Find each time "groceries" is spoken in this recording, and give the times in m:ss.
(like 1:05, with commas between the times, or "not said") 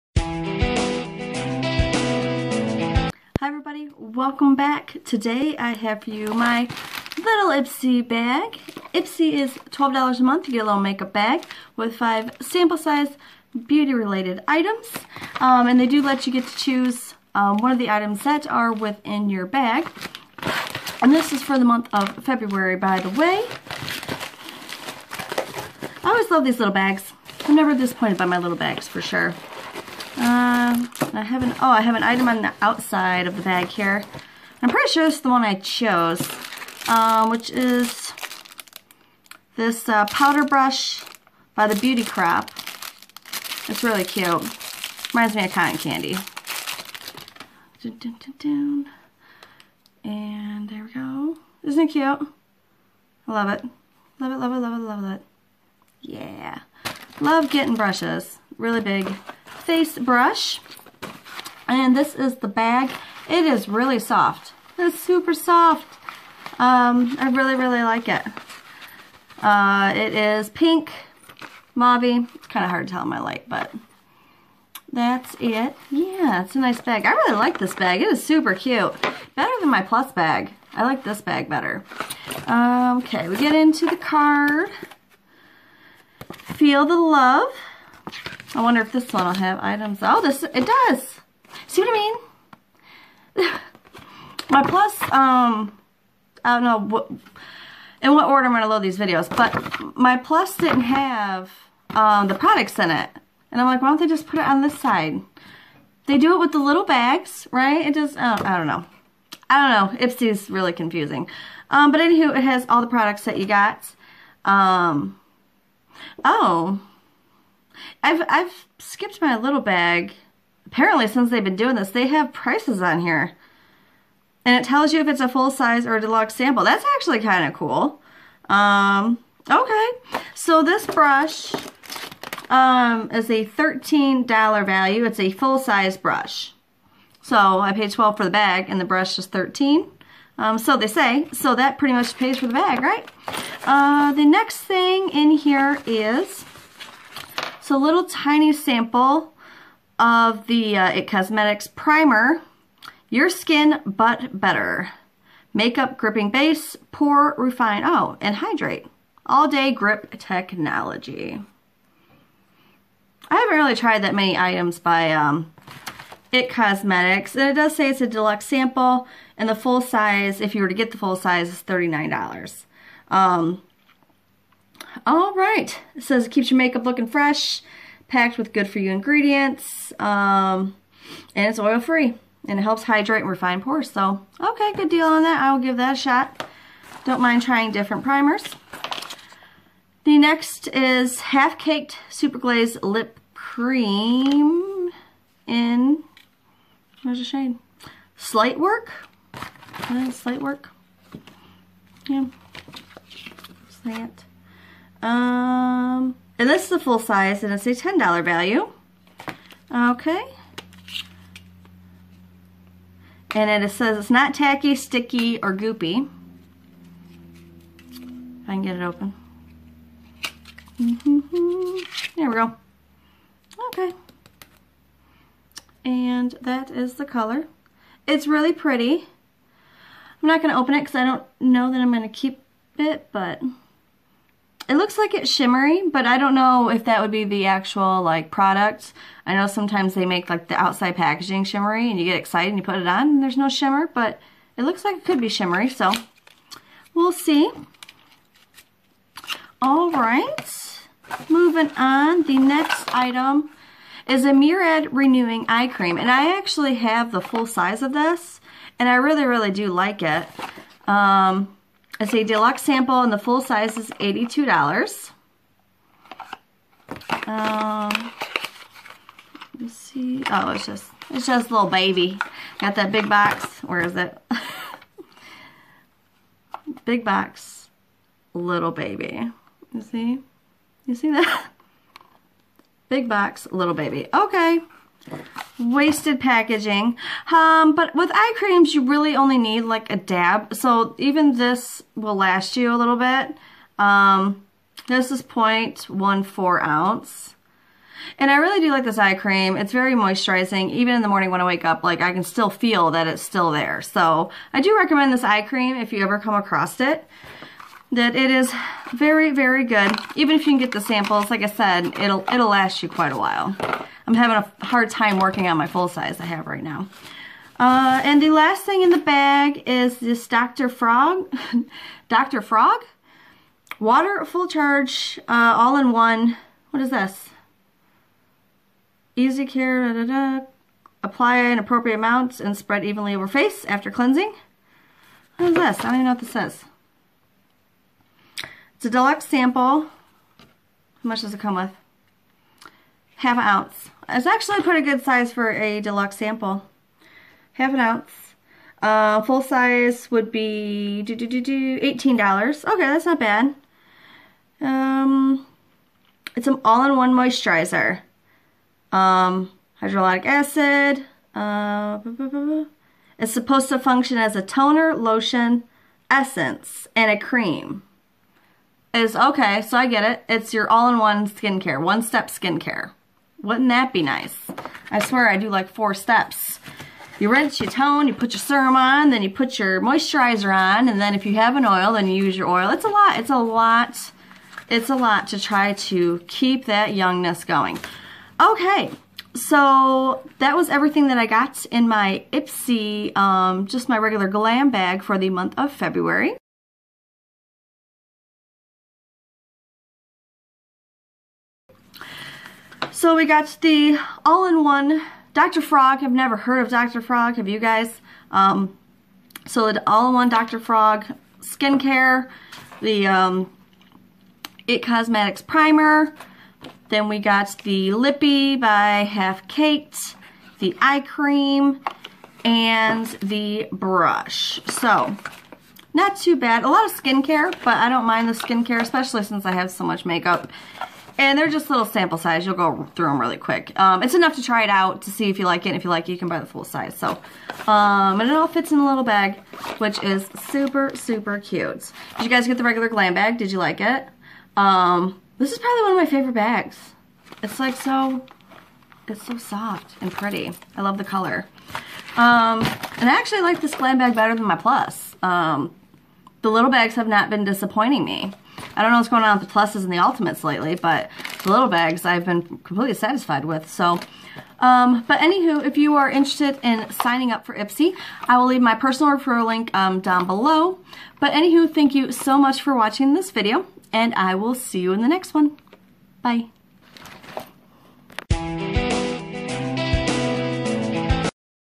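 not said.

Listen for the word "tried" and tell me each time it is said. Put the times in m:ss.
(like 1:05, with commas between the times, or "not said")
2:43.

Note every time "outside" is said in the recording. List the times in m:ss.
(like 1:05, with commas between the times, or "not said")
0:32, 4:00.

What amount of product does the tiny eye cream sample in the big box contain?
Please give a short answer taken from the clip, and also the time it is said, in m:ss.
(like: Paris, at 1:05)
0.14 ounce, at 4:55.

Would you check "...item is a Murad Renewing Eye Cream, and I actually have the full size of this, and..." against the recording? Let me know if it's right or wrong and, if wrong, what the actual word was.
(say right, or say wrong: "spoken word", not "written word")
right.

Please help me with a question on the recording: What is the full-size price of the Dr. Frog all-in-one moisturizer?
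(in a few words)
$18.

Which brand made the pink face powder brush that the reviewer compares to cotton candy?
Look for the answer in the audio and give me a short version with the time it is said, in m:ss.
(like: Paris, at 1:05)
The Beauty Crop, at 0:41.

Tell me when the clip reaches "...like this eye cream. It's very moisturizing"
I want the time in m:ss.
4:58.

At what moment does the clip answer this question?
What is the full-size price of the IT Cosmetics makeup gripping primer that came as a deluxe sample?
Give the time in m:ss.
2:51.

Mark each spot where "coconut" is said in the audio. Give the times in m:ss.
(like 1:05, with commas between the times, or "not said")
not said.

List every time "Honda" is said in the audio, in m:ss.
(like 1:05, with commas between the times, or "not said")
not said.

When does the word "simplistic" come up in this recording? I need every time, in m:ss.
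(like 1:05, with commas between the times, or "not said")
not said.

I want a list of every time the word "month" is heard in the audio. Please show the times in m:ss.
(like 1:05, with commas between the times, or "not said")
0:10, 0:21, 6:35.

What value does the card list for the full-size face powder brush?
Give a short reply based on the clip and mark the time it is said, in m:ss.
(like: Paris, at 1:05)
$13, at 2:13.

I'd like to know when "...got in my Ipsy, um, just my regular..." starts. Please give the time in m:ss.
6:31.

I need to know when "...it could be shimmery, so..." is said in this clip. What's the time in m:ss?
4:04.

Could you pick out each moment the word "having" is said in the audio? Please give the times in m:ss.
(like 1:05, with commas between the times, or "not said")
5:14.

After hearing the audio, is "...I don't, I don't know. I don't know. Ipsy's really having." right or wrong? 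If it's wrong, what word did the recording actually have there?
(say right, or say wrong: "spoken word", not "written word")
wrong: "confusing", not "having".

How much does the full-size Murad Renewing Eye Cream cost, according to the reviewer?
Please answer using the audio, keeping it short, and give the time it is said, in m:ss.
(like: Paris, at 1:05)
$82, at 4:23.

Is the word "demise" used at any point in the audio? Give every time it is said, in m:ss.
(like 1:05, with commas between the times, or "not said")
not said.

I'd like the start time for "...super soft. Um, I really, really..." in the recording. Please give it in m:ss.
1:04.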